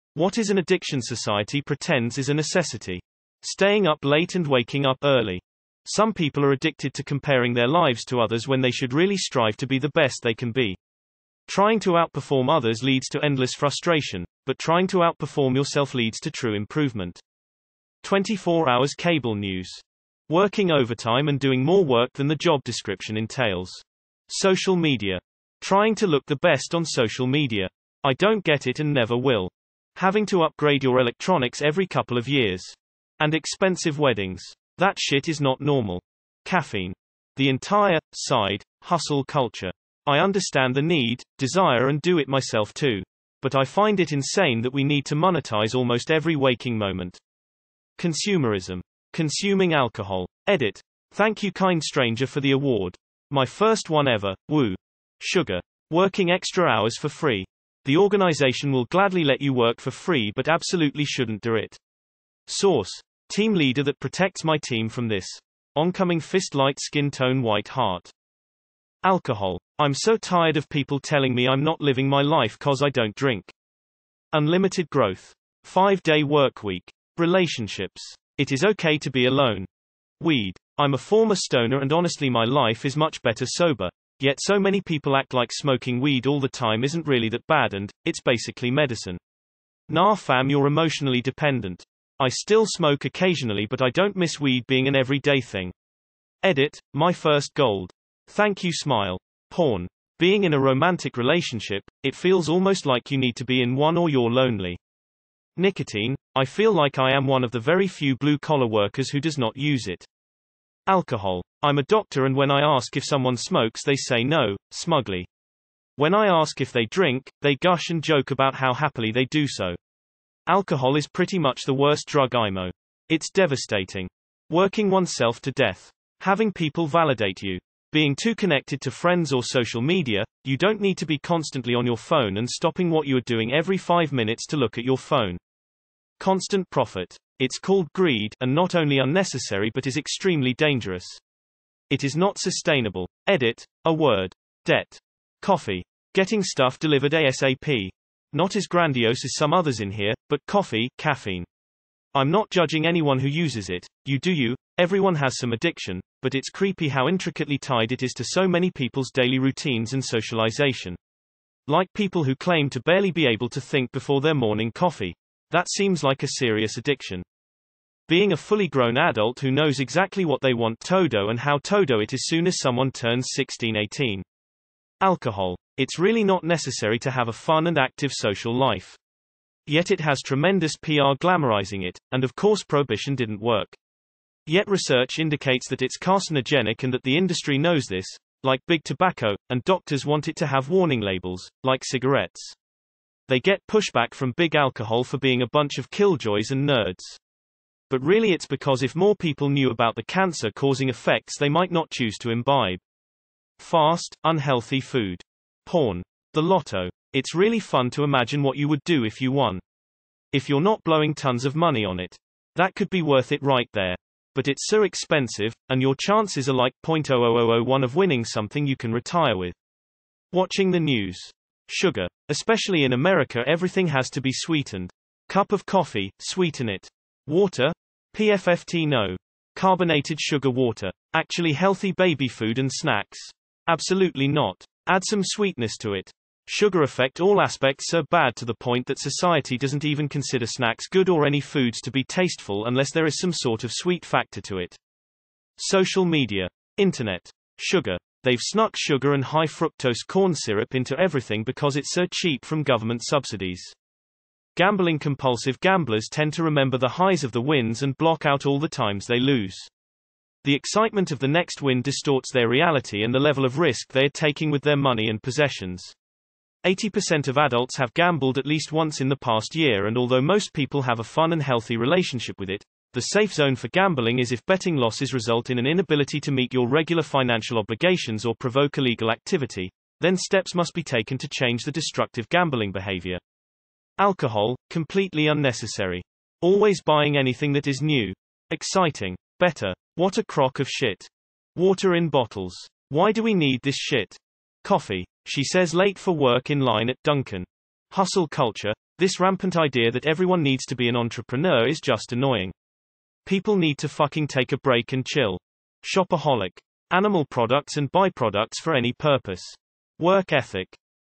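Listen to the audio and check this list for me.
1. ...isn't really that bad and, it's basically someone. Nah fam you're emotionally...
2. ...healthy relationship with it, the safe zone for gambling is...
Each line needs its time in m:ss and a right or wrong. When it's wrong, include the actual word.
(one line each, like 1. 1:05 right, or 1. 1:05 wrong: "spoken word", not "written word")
1. 1:26 wrong: "medicine", not "someone"
2. 4:31 right.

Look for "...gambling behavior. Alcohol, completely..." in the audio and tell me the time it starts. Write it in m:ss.
4:42.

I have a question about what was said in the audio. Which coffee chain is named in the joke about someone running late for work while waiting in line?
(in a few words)
Dunkin'.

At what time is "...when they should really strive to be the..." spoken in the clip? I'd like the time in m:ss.
0:08.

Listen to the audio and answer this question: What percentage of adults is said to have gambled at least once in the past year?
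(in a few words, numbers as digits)
80%.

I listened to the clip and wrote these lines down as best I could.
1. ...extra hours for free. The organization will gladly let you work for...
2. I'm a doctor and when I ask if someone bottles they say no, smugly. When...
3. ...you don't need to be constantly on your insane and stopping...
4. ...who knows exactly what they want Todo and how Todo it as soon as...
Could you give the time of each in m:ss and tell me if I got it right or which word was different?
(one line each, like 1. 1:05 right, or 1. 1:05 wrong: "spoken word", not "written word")
1. 0:56 right
2. 1:51 wrong: "smokes", not "bottles"
3. 2:10 wrong: "phone", not "insane"
4. 2:49 right.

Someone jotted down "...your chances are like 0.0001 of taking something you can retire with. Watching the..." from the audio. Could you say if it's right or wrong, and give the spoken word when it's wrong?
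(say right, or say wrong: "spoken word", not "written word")
wrong: "winning", not "taking".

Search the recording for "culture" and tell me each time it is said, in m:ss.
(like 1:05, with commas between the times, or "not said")
0:39, 4:58.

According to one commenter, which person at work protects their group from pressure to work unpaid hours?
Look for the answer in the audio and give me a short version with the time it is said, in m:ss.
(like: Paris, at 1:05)
Team leader, at 1:03.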